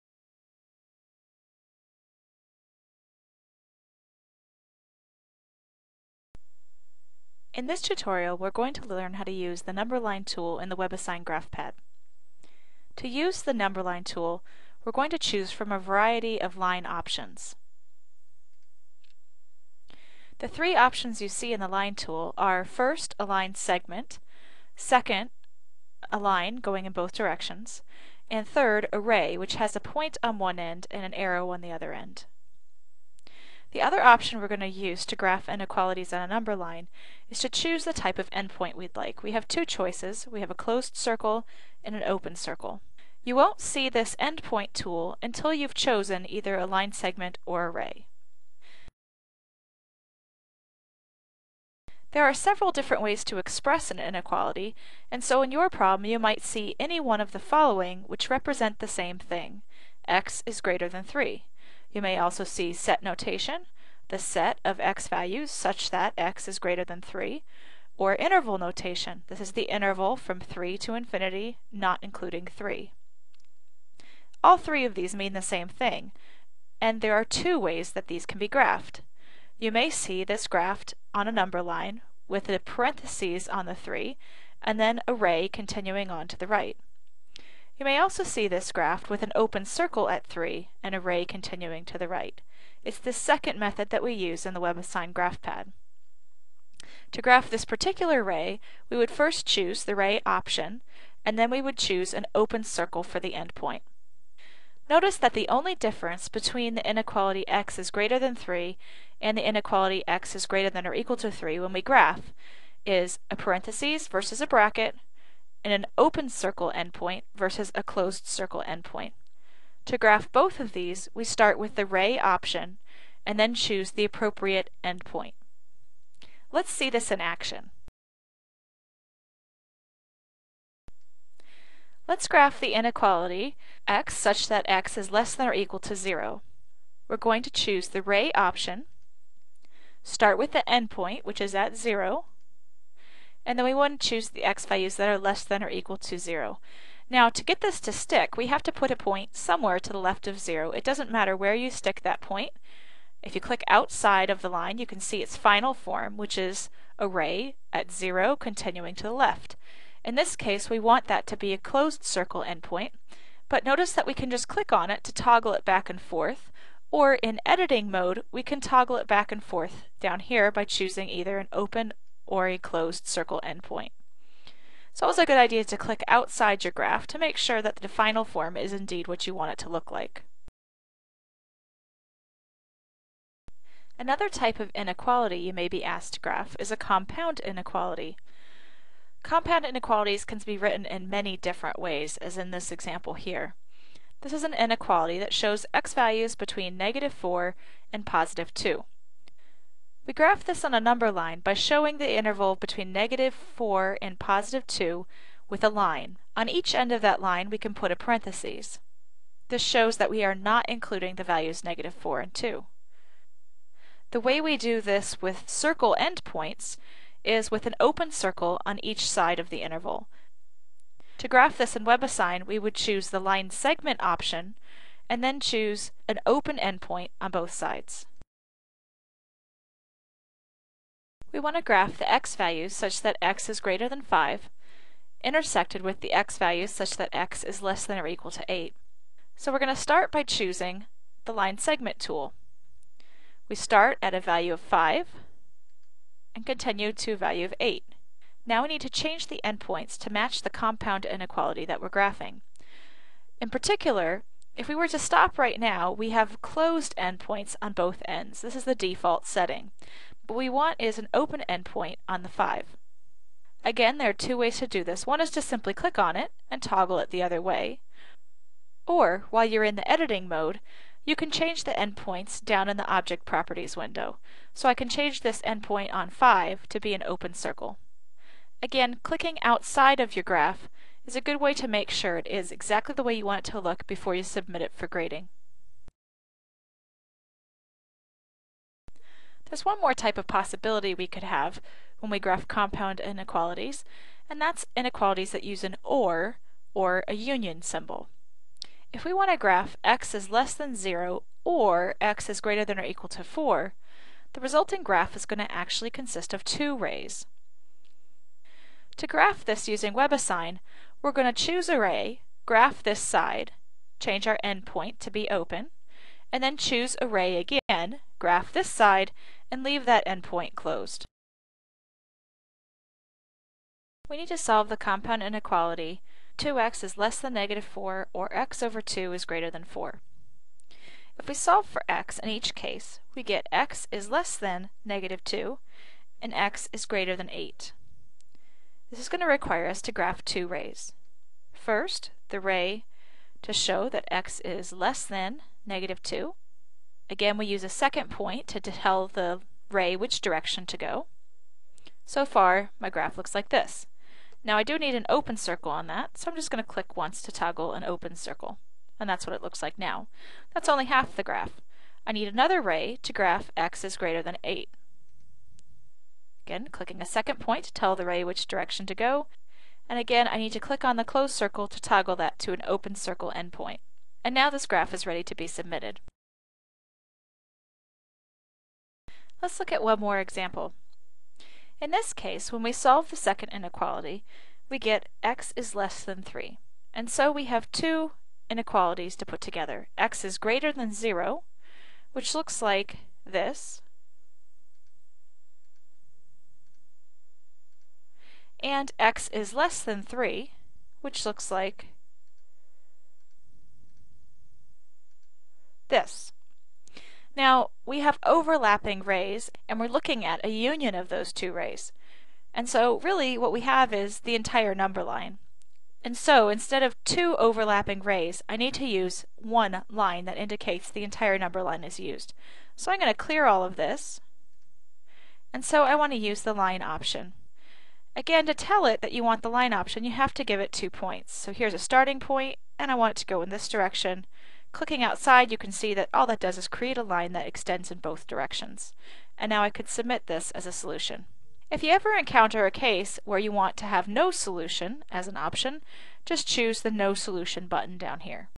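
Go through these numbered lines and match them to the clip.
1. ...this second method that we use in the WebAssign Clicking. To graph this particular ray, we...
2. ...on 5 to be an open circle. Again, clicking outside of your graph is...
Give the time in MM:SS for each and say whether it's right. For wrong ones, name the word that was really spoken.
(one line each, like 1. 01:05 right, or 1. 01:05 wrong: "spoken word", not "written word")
1. 01:32 wrong: "GraphPad", not "Clicking"
2. 04:35 right.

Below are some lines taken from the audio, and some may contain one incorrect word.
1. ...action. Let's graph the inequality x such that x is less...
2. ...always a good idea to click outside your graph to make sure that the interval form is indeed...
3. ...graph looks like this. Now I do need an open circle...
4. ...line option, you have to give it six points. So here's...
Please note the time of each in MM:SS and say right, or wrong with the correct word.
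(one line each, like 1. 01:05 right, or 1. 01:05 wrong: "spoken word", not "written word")
1. 02:07 right
2. 02:55 wrong: "final", not "interval"
3. 05:52 right
4. 07:09 wrong: "two", not "six".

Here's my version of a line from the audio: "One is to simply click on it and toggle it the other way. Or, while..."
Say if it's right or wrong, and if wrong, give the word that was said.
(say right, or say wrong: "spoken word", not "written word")
right.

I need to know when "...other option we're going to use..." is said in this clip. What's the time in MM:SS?
00:33.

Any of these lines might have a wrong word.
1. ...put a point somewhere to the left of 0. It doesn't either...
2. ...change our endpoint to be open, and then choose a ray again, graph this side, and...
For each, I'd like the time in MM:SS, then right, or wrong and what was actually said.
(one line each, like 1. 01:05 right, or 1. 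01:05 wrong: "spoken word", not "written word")
1. 02:28 wrong: "matter", not "either"
2. 05:13 right.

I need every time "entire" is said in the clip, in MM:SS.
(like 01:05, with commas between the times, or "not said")
06:54, 07:01.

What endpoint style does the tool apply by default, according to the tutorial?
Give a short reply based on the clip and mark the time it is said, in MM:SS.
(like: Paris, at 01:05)
closed endpoints, at 04:16.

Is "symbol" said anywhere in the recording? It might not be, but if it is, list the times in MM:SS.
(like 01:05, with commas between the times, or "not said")
04:57.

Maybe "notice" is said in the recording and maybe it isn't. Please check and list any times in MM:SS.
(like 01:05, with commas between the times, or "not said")
01:44, 02:43.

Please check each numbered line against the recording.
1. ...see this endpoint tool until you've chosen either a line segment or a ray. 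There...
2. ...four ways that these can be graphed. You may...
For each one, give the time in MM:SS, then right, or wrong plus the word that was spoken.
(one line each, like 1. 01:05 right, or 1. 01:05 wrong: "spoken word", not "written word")
1. 00:43 right
2. 01:17 wrong: "two", not "four".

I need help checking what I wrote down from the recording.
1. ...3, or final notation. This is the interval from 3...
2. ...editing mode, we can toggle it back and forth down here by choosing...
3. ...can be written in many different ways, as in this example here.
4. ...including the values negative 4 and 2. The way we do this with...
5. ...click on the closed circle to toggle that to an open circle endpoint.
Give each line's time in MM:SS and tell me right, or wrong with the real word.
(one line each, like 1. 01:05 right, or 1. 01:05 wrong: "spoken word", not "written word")
1. 01:07 wrong: "interval", not "final"
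2. 02:47 right
3. 03:10 right
4. 03:30 right
5. 06:10 right.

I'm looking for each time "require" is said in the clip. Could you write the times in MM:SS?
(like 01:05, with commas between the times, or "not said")
05:39.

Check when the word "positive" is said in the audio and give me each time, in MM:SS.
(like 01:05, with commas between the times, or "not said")
03:18, 03:24.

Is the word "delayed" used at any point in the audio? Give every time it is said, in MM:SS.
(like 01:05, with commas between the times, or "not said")
not said.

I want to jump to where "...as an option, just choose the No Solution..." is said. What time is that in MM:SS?
07:25.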